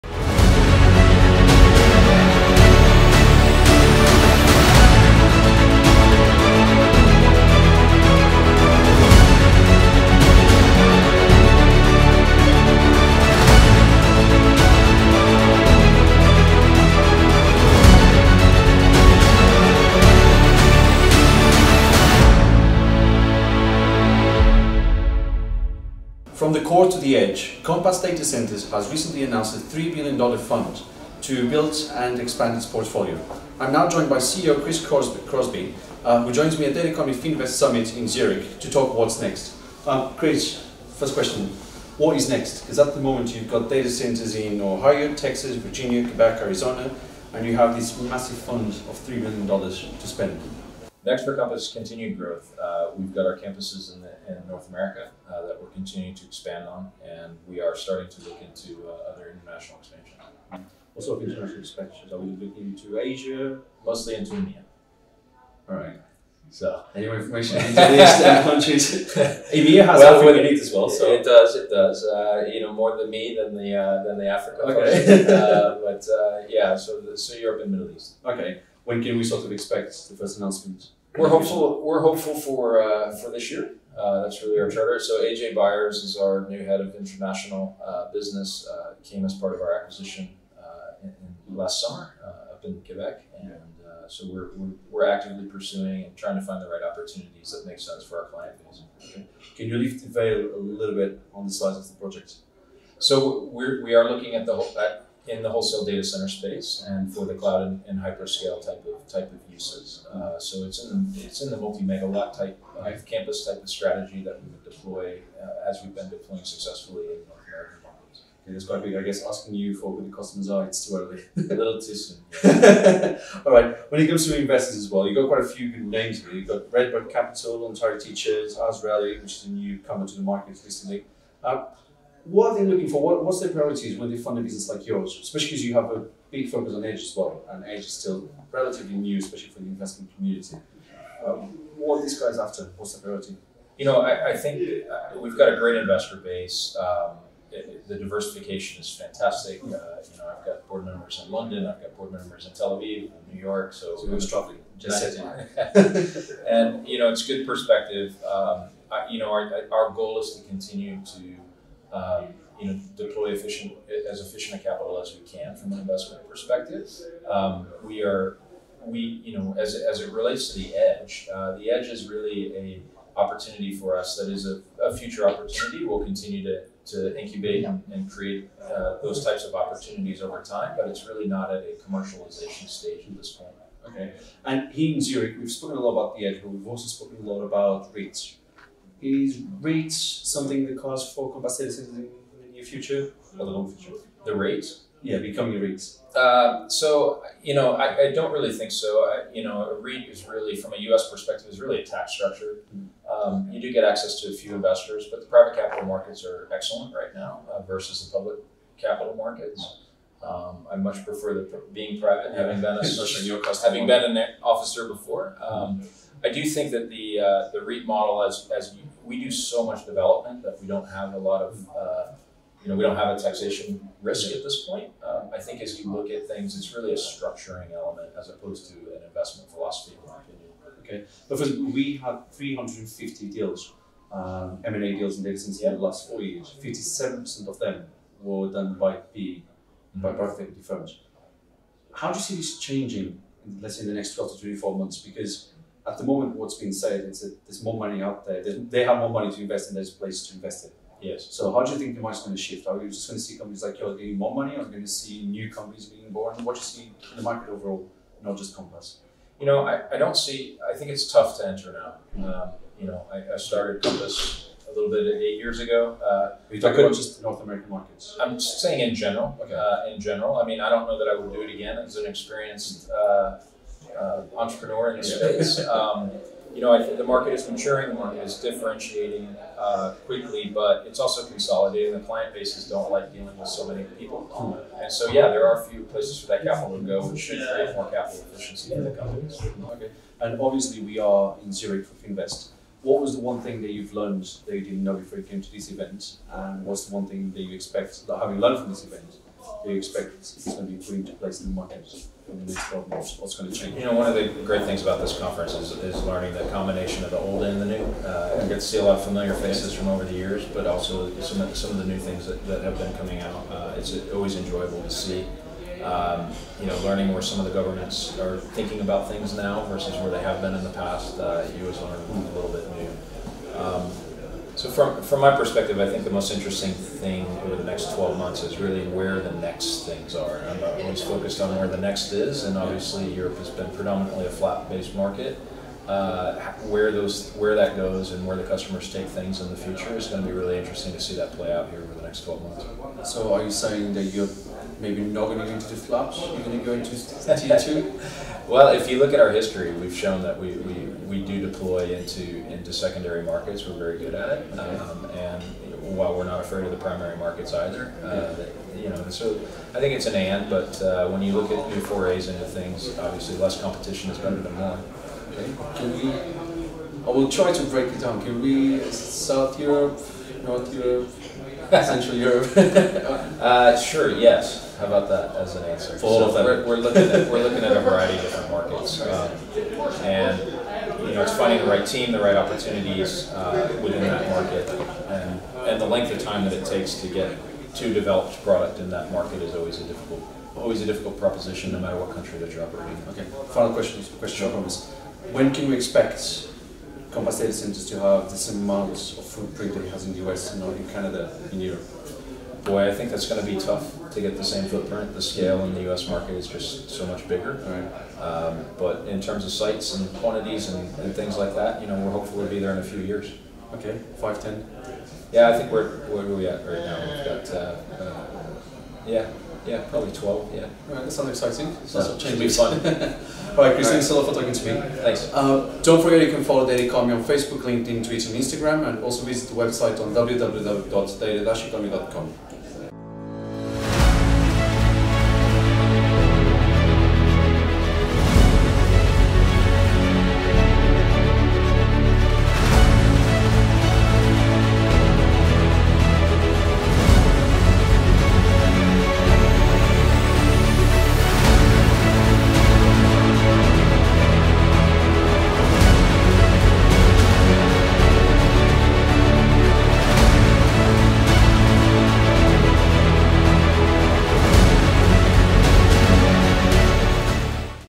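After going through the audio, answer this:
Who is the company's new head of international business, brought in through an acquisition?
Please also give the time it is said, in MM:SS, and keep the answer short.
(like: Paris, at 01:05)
AJ Byers, at 01:25.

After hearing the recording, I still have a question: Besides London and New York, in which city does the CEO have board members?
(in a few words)
Tel Aviv.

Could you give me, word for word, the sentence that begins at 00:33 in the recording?
I'm now joined by CEO Chris Crosby, uh, who joins me at Telecom Finvest Summit in Zurich to talk what's next.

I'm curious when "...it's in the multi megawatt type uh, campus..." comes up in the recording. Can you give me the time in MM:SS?
01:51.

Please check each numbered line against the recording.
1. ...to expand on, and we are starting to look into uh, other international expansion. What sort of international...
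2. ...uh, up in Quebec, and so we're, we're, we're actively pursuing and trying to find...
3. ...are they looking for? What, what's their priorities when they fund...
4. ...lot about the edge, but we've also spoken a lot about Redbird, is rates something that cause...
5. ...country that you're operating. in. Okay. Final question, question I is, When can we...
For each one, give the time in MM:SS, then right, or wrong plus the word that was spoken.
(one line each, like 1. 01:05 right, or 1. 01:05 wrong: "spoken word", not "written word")
1. 00:56 right
2. 01:32 right
3. 02:12 right
4. 03:05 wrong: "REITs", not "Redbird"
5. 06:32 right.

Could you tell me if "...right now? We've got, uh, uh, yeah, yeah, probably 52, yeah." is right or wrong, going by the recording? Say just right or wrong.
wrong.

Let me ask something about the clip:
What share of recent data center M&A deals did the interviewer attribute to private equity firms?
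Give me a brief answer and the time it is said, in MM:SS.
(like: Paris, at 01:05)
57%, at 03:56.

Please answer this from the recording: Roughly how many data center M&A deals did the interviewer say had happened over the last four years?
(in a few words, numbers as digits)
350.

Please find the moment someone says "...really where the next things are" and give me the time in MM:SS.
05:28.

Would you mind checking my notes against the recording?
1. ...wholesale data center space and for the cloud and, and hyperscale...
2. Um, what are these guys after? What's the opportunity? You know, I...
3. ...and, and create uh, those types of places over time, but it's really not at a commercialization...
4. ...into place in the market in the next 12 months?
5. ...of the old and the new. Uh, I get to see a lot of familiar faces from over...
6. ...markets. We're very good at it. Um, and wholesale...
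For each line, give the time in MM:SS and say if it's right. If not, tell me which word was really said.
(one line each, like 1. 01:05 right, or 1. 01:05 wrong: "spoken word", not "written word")
1. 01:45 right
2. 02:21 wrong: "priority", not "opportunity"
3. 02:57 wrong: "opportunities", not "places"
4. 05:00 right
5. 05:07 right
6. 05:53 wrong: "while", not "wholesale".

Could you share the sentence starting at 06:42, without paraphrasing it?
Boy, I think that's going to be tough to get the same footprint.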